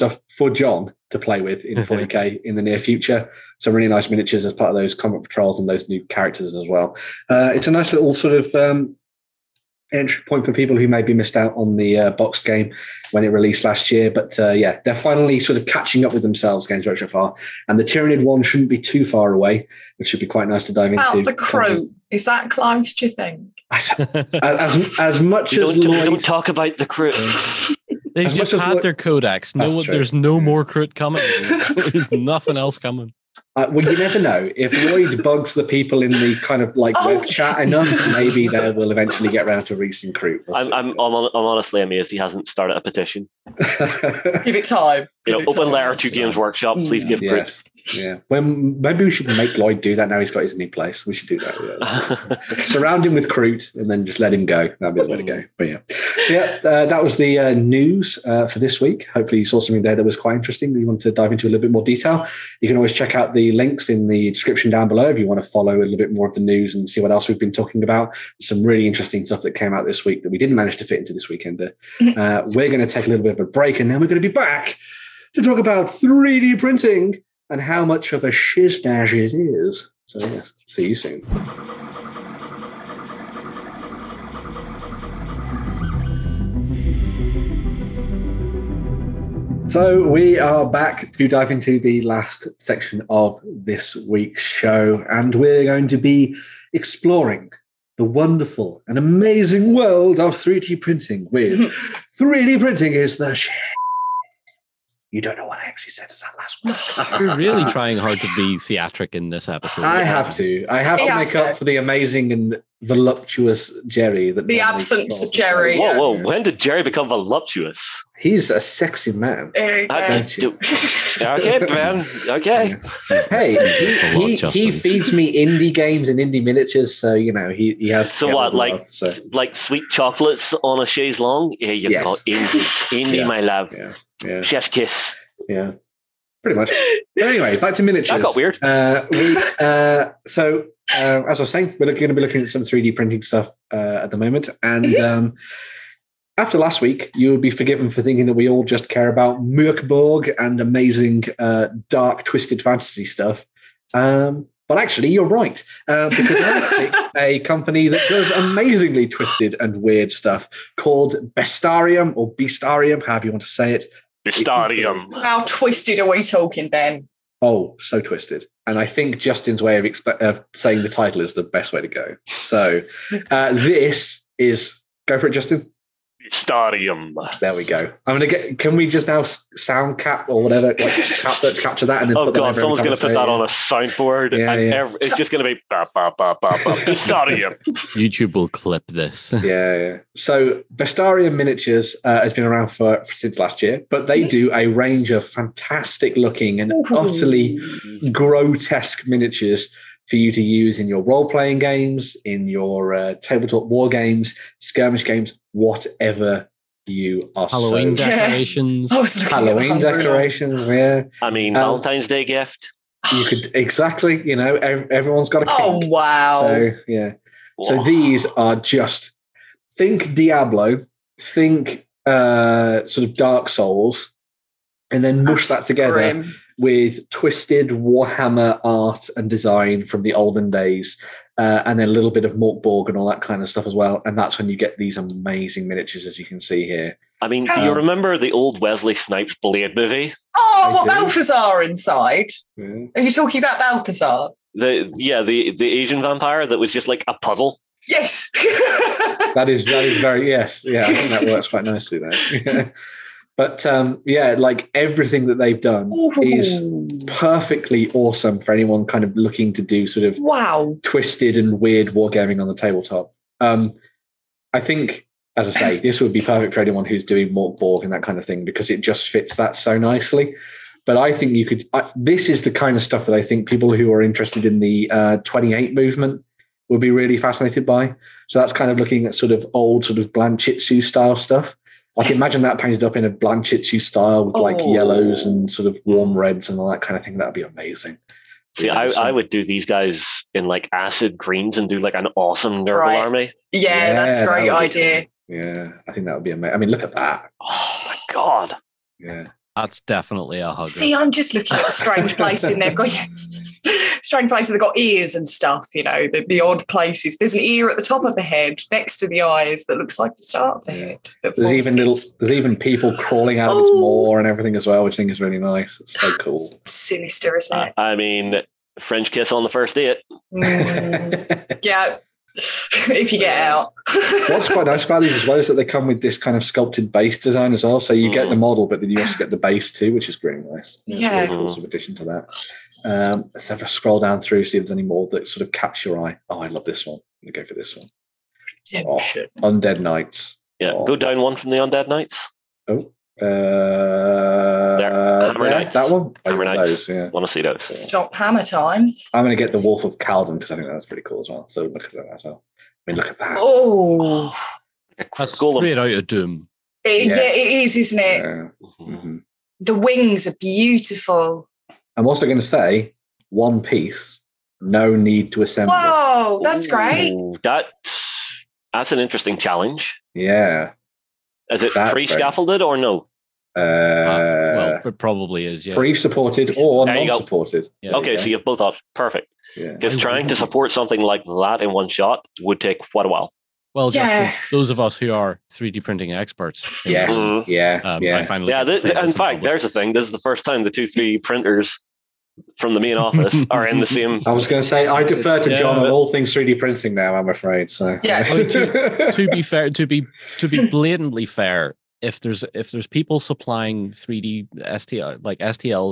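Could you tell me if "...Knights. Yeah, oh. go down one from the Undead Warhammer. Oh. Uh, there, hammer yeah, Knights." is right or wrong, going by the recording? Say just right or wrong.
wrong.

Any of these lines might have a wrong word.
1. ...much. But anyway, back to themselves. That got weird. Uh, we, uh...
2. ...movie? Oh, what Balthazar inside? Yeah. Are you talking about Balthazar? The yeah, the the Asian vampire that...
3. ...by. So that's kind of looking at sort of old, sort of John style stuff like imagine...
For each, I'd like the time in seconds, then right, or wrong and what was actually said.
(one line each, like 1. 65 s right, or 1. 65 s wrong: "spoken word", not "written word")
1. 136 s wrong: "miniatures", not "themselves"
2. 239 s right
3. 277 s wrong: "Blanchitsu", not "John".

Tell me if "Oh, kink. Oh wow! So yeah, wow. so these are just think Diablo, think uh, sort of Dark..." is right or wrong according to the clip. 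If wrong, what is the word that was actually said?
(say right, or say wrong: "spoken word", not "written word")
right.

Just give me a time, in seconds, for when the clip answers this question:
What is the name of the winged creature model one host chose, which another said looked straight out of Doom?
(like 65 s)
349 s.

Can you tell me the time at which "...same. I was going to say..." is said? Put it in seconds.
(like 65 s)
393 s.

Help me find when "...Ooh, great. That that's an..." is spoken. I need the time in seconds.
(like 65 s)
366 s.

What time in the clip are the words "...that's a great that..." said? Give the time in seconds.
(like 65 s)
293 s.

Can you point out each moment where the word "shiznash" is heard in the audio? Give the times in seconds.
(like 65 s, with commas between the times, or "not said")
78 s.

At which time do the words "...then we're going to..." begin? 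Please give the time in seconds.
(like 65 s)
73 s.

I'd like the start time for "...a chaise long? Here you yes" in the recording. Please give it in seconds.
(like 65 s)
130 s.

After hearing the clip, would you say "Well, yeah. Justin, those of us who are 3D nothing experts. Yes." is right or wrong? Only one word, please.
wrong.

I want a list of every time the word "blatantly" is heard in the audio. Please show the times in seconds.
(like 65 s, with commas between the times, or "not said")
400 s.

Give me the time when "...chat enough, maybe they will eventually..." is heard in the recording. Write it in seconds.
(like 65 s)
37 s.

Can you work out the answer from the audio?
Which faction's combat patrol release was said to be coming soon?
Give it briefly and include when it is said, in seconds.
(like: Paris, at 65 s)
Tyranid, at 17 s.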